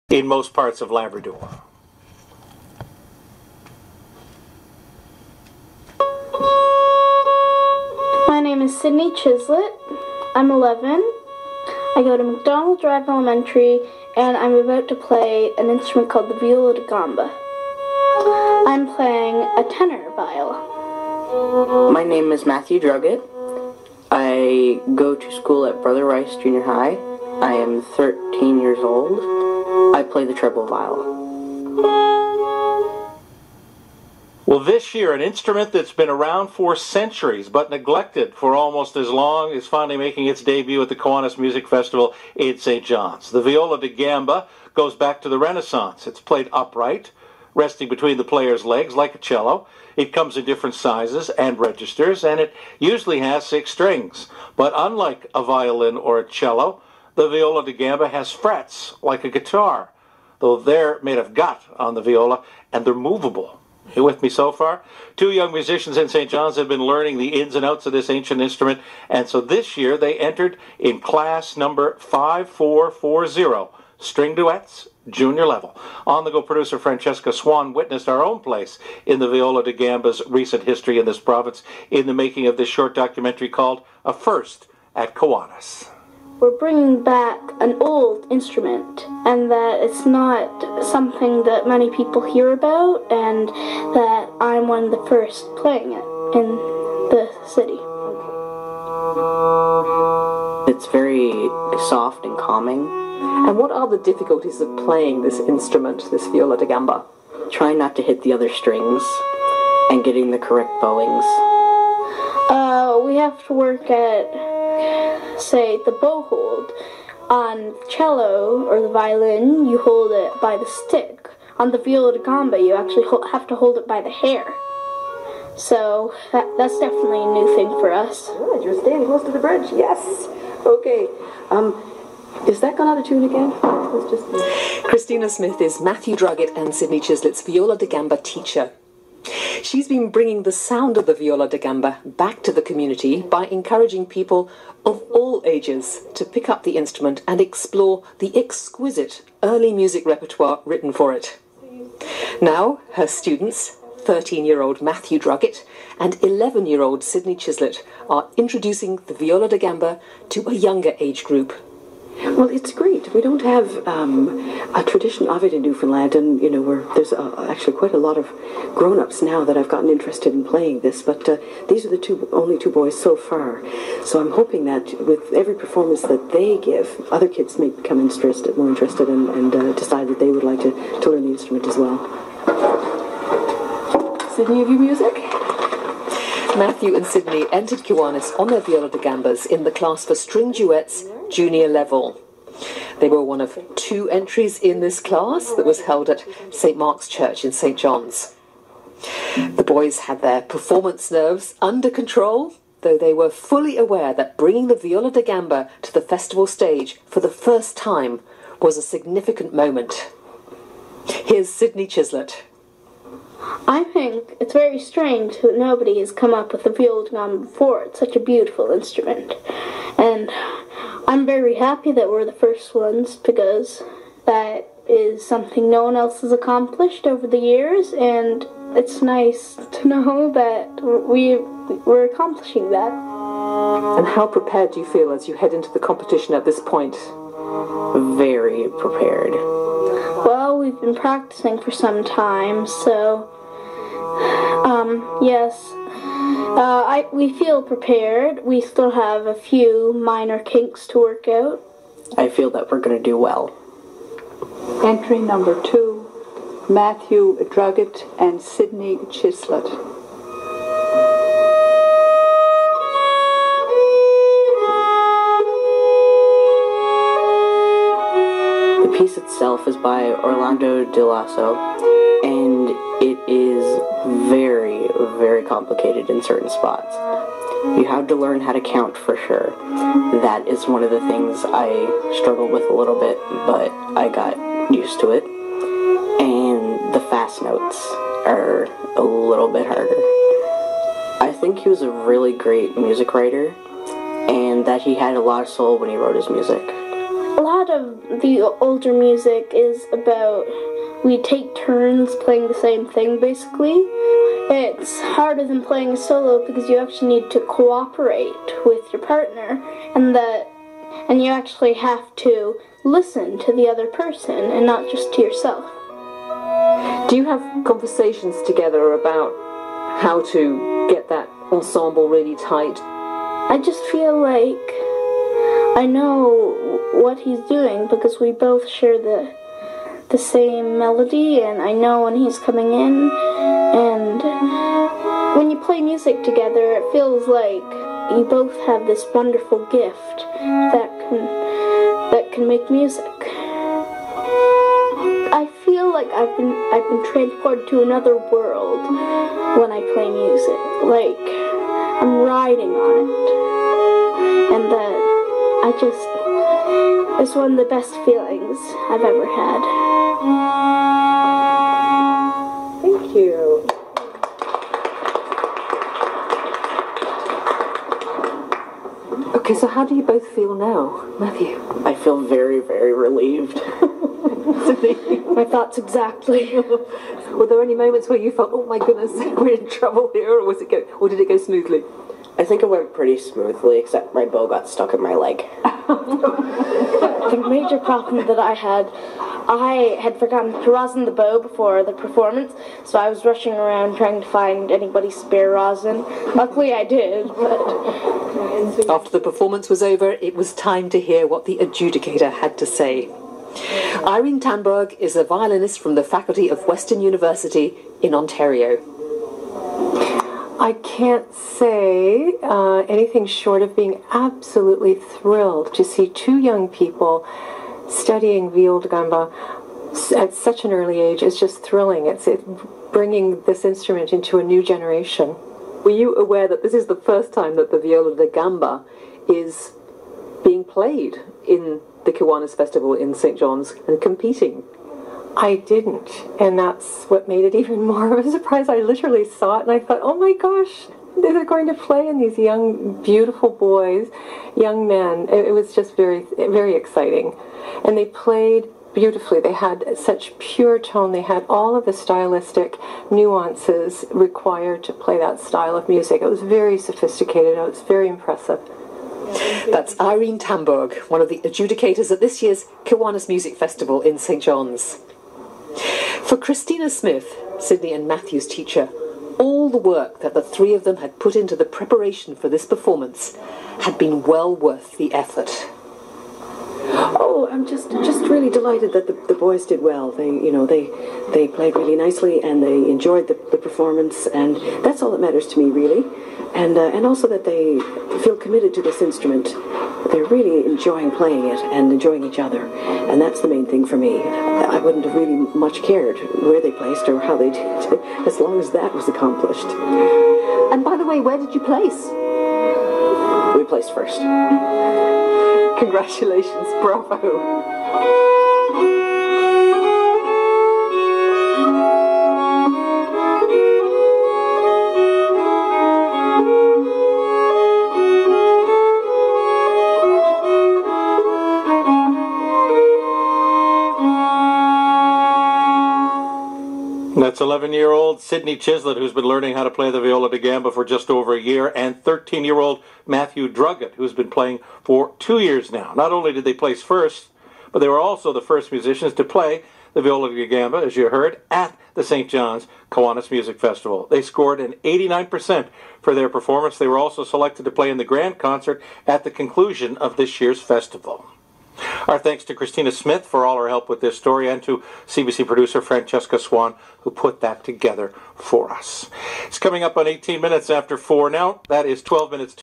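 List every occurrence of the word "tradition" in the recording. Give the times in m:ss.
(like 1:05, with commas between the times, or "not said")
2:44.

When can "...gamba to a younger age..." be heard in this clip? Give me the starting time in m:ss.
2:39.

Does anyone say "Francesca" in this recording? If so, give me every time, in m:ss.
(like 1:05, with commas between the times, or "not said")
1:16, 9:15.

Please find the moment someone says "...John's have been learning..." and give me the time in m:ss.
1:06.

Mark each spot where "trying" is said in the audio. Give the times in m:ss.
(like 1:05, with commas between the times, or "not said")
1:47, 6:33.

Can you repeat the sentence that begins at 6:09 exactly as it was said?
Okay, so how do you both feel now, Matthew?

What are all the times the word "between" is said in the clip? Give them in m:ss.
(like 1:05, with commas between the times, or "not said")
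0:47.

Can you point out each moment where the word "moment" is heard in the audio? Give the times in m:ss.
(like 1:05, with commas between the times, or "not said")
3:29, 6:17.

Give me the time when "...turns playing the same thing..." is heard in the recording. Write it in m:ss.
5:01.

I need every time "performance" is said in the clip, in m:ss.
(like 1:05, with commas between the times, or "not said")
2:55, 3:20, 6:31, 6:39, 7:52, 8:03, 9:06.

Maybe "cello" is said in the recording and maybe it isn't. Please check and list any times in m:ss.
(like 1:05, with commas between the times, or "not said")
0:49, 0:56, 1:57.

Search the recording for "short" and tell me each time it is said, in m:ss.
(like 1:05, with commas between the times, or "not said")
1:22, 6:53.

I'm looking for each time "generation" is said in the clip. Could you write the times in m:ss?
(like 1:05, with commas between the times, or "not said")
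7:04.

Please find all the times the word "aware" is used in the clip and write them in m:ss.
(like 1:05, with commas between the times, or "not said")
3:23, 7:06.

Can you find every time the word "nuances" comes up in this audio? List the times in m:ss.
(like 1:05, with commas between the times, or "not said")
7:33.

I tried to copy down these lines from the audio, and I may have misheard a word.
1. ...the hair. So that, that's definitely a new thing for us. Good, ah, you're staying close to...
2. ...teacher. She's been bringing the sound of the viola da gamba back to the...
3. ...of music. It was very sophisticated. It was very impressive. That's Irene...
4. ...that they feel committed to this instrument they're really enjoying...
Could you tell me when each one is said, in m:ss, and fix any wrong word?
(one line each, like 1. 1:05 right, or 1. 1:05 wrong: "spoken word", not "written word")
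1. 2:04 right
2. 2:18 right
3. 7:35 right
4. 8:07 right.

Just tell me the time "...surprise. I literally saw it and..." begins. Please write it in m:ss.
7:18.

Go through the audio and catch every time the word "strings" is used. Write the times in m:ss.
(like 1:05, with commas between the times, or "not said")
0:53, 1:13, 1:48, 3:10.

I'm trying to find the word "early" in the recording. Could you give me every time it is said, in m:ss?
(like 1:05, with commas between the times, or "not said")
2:29, 7:00.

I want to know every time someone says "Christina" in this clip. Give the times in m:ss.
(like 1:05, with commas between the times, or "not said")
2:14, 7:46, 9:12.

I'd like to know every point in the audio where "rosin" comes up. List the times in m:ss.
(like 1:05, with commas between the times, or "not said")
6:30, 6:35.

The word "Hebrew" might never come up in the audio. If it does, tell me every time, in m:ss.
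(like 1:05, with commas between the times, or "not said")
not said.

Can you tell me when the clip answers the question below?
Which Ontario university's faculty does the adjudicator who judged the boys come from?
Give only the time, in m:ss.
6:46.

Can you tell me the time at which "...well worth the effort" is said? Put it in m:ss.
7:54.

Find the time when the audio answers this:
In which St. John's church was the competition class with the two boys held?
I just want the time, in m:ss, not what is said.
3:16.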